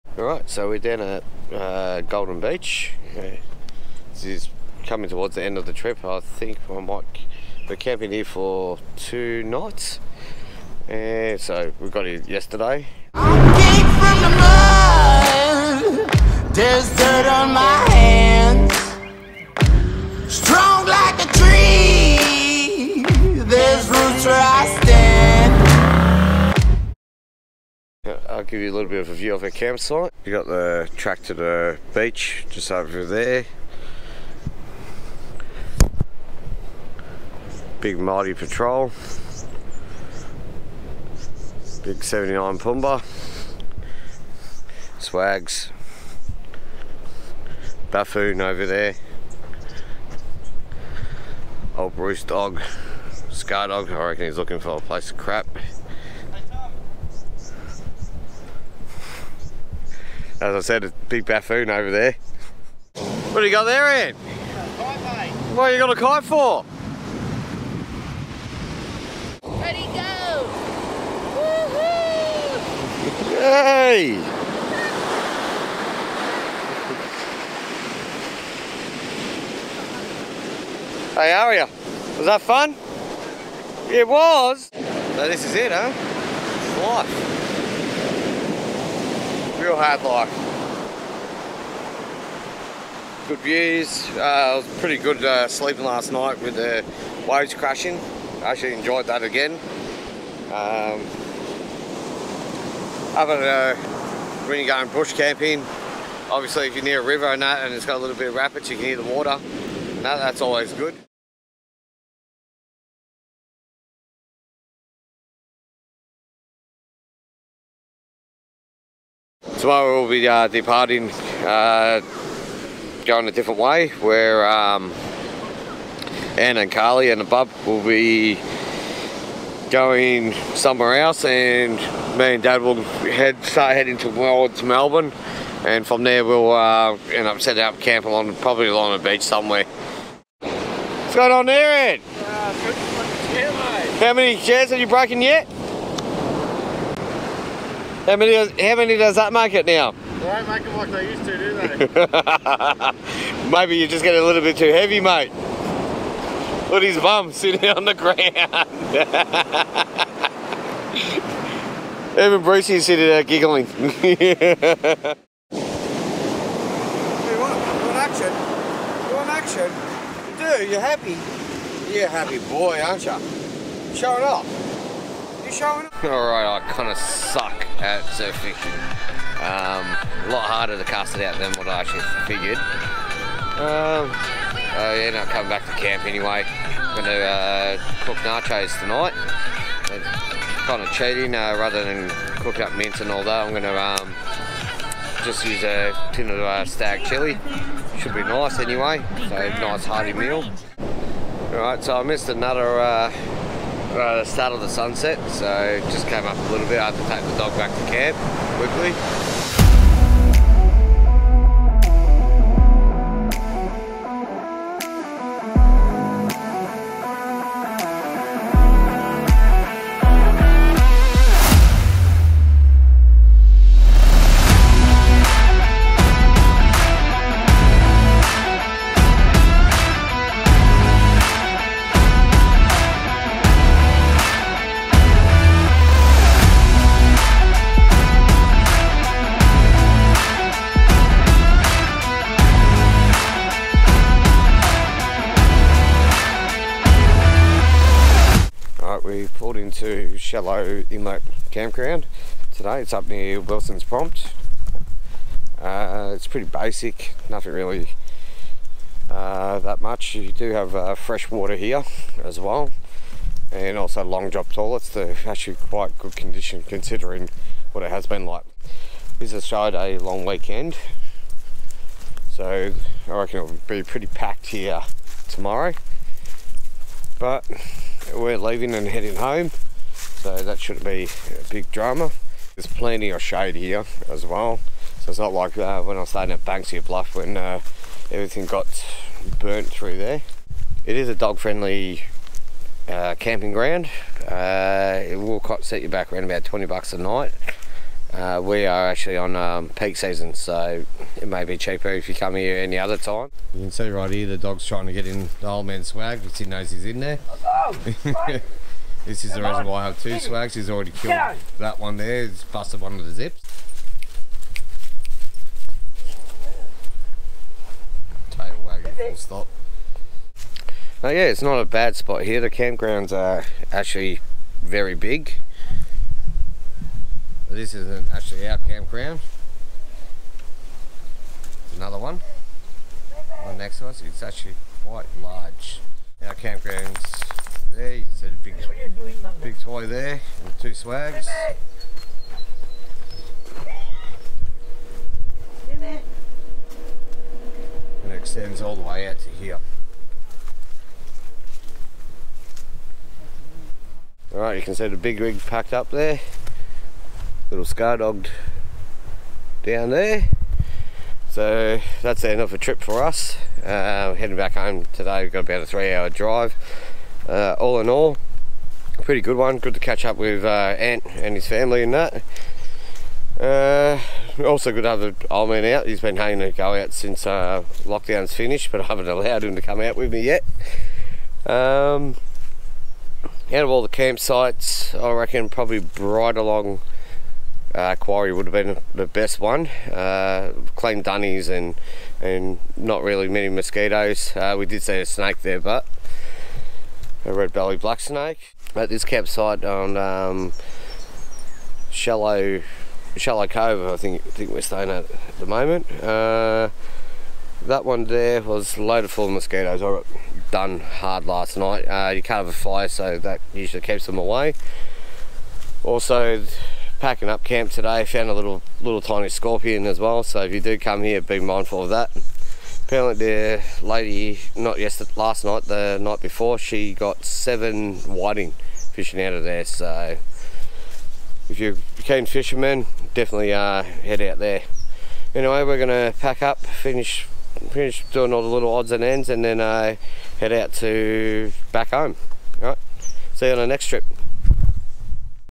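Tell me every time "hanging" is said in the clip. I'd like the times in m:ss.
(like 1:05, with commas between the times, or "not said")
6:16.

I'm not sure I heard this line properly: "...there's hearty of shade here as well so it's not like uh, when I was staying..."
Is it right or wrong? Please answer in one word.
wrong.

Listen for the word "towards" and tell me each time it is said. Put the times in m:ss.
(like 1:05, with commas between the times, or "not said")
0:05, 2:13.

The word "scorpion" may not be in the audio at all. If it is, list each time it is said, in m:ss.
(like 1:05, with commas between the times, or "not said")
6:59.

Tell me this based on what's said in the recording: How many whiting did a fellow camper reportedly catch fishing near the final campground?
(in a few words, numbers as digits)
7.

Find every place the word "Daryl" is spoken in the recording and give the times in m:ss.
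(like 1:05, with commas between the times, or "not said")
not said.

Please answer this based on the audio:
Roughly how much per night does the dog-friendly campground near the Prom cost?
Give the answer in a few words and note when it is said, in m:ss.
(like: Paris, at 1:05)
$20, at 4:56.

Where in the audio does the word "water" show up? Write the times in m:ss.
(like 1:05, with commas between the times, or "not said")
1:49, 4:21.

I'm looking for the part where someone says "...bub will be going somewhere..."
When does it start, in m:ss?
2:07.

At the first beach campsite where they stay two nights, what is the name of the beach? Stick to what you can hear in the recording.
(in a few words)
Golden Beach.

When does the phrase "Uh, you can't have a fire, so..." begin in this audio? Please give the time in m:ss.
6:51.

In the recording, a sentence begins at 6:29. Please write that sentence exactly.
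Uh, clean dunnies and and not really many mosquitoes.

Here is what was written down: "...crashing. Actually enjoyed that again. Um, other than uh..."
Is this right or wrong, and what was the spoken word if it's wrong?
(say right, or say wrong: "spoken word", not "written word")
right.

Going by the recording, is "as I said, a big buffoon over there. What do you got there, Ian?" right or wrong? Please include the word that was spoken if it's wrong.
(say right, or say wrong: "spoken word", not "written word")
right.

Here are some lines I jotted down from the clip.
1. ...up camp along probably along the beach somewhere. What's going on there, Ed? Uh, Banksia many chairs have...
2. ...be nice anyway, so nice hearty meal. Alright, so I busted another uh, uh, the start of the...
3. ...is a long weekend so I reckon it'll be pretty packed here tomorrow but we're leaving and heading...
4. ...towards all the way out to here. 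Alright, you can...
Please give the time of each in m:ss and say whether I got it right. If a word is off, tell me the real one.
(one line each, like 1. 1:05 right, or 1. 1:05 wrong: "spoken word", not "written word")
1. 2:17 wrong: "How", not "Banksia"
2. 3:18 wrong: "missed", not "busted"
3. 4:29 right
4. 5:48 wrong: "extends", not "towards".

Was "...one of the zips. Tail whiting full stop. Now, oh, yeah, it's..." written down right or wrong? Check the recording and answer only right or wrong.
wrong.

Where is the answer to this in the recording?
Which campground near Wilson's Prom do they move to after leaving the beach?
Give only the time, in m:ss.
4:10.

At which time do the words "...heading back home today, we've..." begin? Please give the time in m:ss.
6:04.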